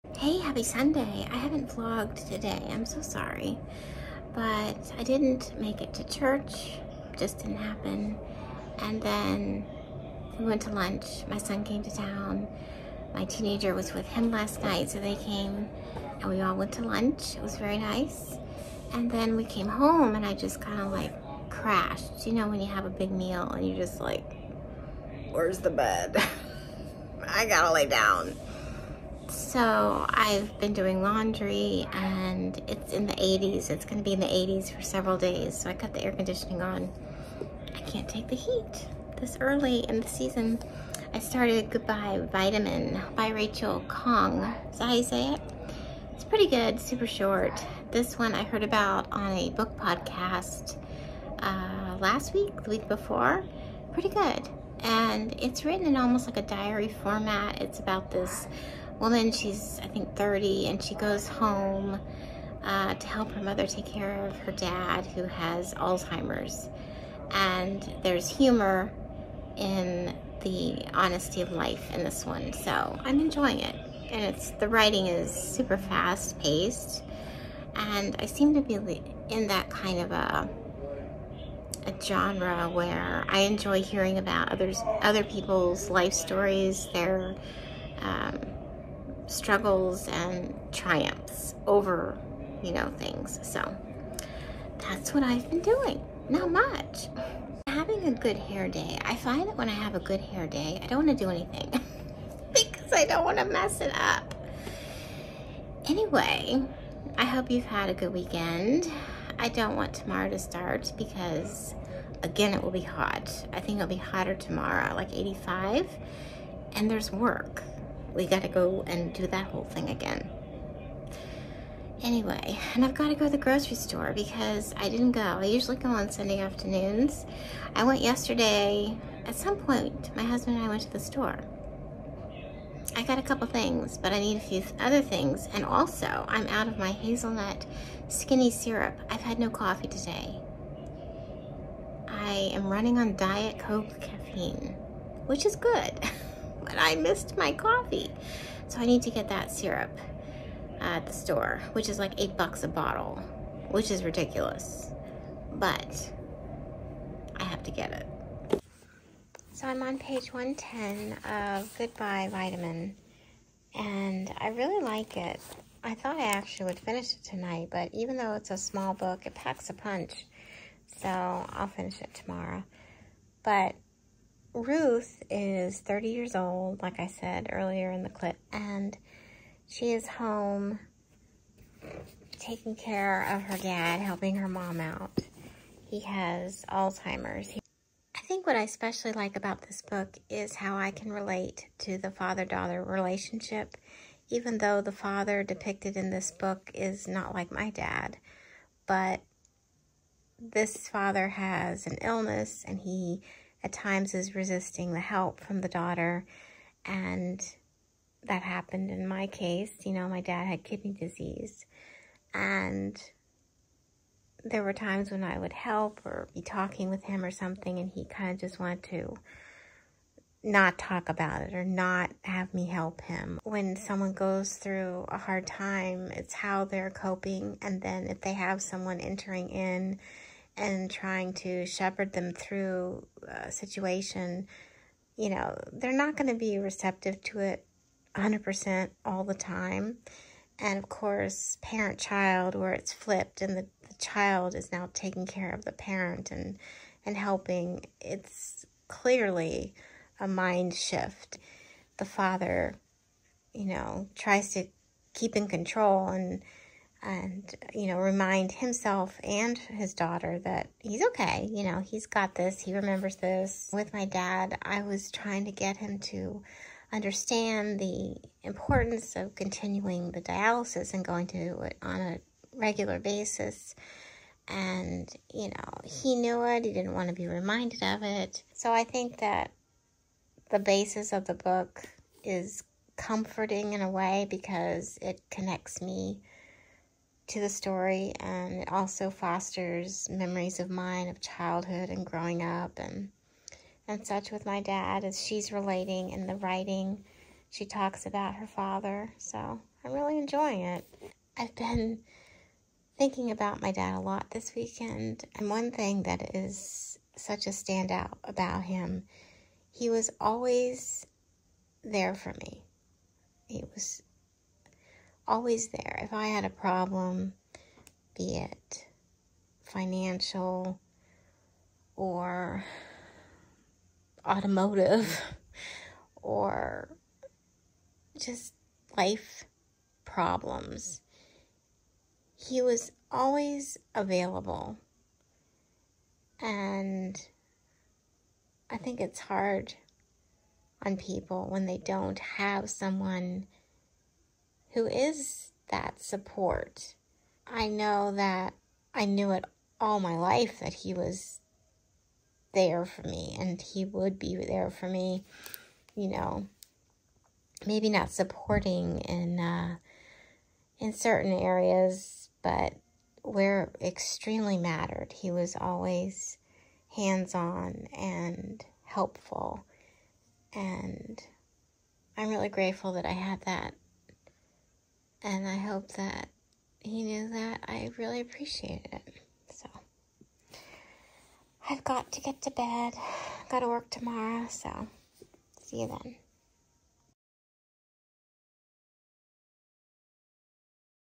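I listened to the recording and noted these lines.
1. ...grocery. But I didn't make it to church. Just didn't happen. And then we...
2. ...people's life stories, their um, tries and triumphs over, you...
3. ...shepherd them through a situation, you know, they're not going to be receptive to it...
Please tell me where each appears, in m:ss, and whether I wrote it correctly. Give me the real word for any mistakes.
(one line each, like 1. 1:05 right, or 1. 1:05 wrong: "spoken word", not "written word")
1. 0:03 wrong: "sorry", not "grocery"
2. 1:25 wrong: "struggles", not "tries"
3. 3:51 right.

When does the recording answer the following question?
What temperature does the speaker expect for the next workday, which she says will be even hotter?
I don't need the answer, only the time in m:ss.
1:55.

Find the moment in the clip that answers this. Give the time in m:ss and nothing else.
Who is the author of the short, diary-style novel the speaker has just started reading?
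0:43.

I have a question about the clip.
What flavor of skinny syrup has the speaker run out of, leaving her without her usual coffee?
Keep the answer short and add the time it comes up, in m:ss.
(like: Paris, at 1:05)
Hazelnut, at 2:16.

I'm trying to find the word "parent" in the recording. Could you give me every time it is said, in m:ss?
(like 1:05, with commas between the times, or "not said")
4:01, 4:05.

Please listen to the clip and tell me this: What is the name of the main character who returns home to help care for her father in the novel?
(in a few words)
Ruth.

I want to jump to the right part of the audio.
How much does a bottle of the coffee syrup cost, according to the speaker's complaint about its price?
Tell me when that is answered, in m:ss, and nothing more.
2:32.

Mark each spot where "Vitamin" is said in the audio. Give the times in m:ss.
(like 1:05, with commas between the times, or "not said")
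0:42, 2:42.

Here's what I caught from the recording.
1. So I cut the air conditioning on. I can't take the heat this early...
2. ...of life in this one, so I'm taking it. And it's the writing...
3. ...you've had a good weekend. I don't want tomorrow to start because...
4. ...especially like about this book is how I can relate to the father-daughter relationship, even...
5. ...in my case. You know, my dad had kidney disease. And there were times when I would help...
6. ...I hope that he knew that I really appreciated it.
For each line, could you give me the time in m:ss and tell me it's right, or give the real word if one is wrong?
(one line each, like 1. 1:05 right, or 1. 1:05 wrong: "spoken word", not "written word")
1. 0:35 right
2. 1:11 wrong: "enjoying", not "taking"
3. 1:47 right
4. 3:08 right
5. 3:28 right
6. 6:15 right.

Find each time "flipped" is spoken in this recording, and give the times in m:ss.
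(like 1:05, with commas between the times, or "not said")
4:02.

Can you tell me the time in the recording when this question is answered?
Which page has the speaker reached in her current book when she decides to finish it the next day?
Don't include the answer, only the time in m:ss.
2:40.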